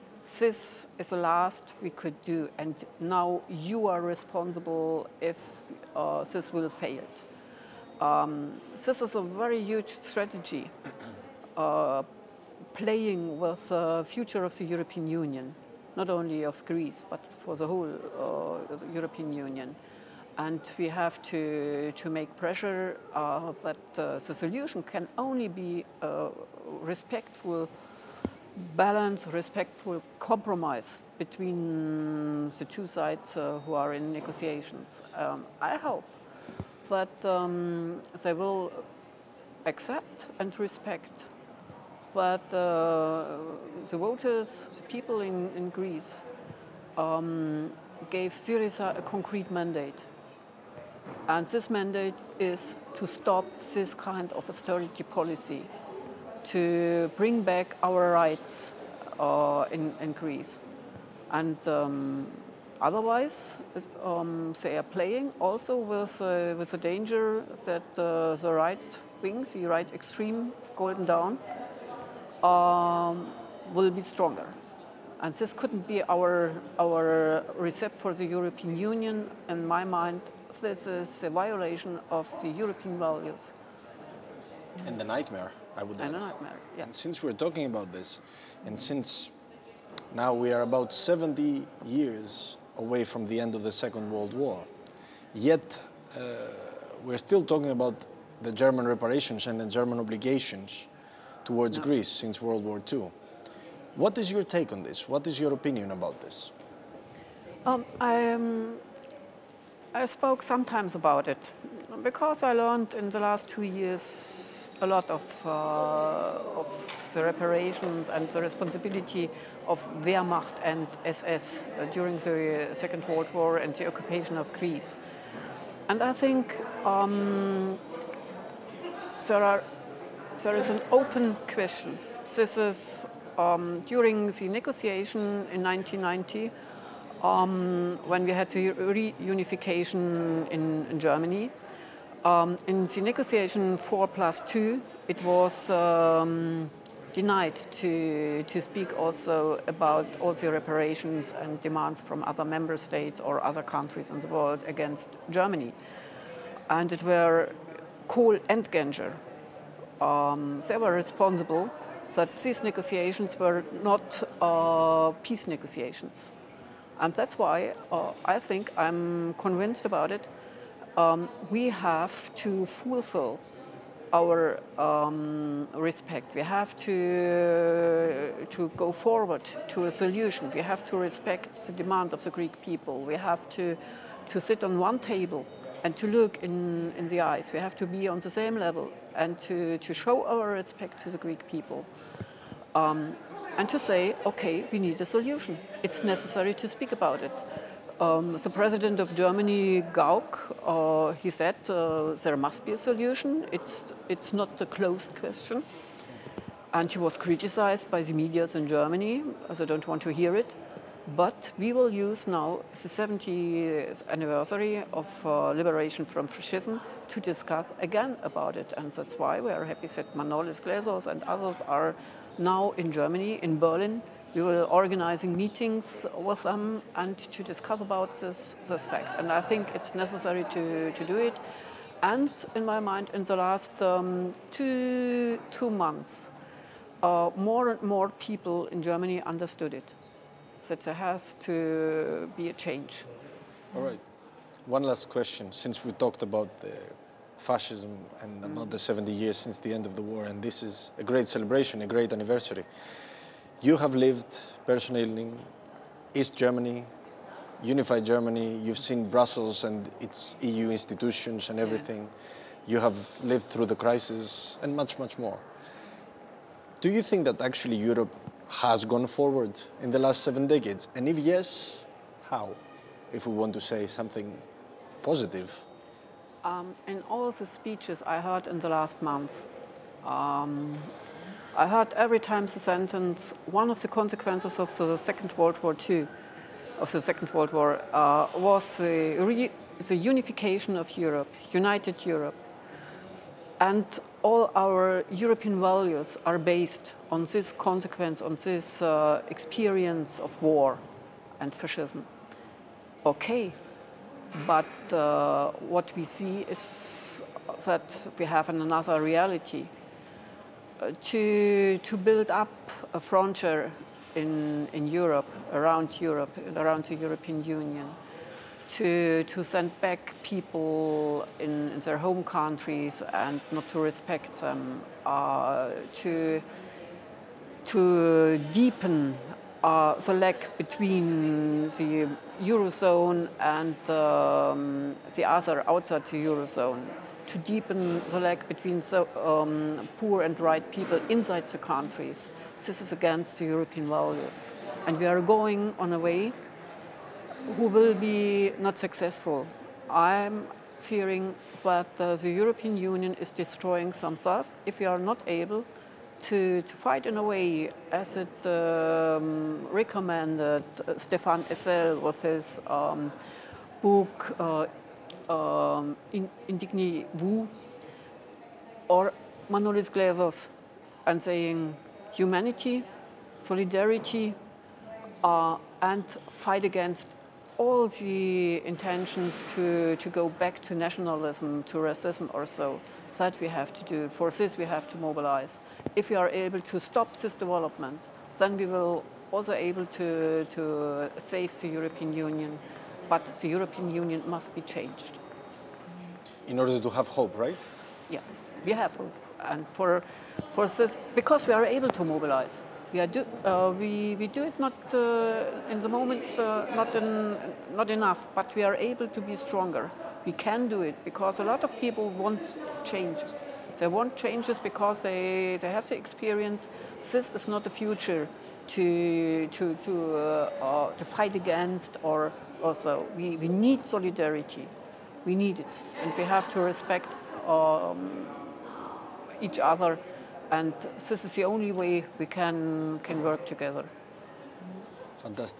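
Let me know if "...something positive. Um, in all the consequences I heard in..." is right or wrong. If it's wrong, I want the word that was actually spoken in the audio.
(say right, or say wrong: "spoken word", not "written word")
wrong: "speeches", not "consequences".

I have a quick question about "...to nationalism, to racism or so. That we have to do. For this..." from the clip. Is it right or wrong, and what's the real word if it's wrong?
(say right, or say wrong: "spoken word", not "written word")
right.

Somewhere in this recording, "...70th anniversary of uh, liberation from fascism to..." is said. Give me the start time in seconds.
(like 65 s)
212 s.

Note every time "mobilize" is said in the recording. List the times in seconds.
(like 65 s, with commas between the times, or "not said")
385 s, 402 s.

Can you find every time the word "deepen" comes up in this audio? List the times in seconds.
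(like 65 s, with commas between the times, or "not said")
328 s, 337 s.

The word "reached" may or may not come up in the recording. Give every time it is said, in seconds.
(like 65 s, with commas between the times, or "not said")
not said.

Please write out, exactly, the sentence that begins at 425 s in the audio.
We need it, and we have to respect um, each other and this is the only way we can, can work together.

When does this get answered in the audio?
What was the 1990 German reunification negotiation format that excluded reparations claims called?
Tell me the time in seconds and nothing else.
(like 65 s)
143 s.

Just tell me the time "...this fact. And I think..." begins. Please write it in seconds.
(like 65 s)
228 s.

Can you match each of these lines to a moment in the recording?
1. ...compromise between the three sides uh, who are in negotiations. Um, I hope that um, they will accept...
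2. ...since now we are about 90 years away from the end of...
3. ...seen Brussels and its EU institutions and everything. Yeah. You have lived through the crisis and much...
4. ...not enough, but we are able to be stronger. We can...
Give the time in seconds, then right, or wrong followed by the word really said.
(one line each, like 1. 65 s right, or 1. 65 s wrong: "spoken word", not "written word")
1. 30 s wrong: "two", not "three"
2. 88 s wrong: "70", not "90"
3. 258 s right
4. 407 s right.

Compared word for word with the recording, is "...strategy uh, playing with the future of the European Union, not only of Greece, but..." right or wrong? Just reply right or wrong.
right.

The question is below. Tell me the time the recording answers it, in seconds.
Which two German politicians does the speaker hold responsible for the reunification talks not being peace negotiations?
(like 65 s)
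158 s.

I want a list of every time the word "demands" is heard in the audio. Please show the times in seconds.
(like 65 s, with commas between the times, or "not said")
151 s, 181 s.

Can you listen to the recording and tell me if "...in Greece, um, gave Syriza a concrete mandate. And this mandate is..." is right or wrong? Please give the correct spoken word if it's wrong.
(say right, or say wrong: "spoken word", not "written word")
right.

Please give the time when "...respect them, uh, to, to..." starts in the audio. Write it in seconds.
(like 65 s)
323 s.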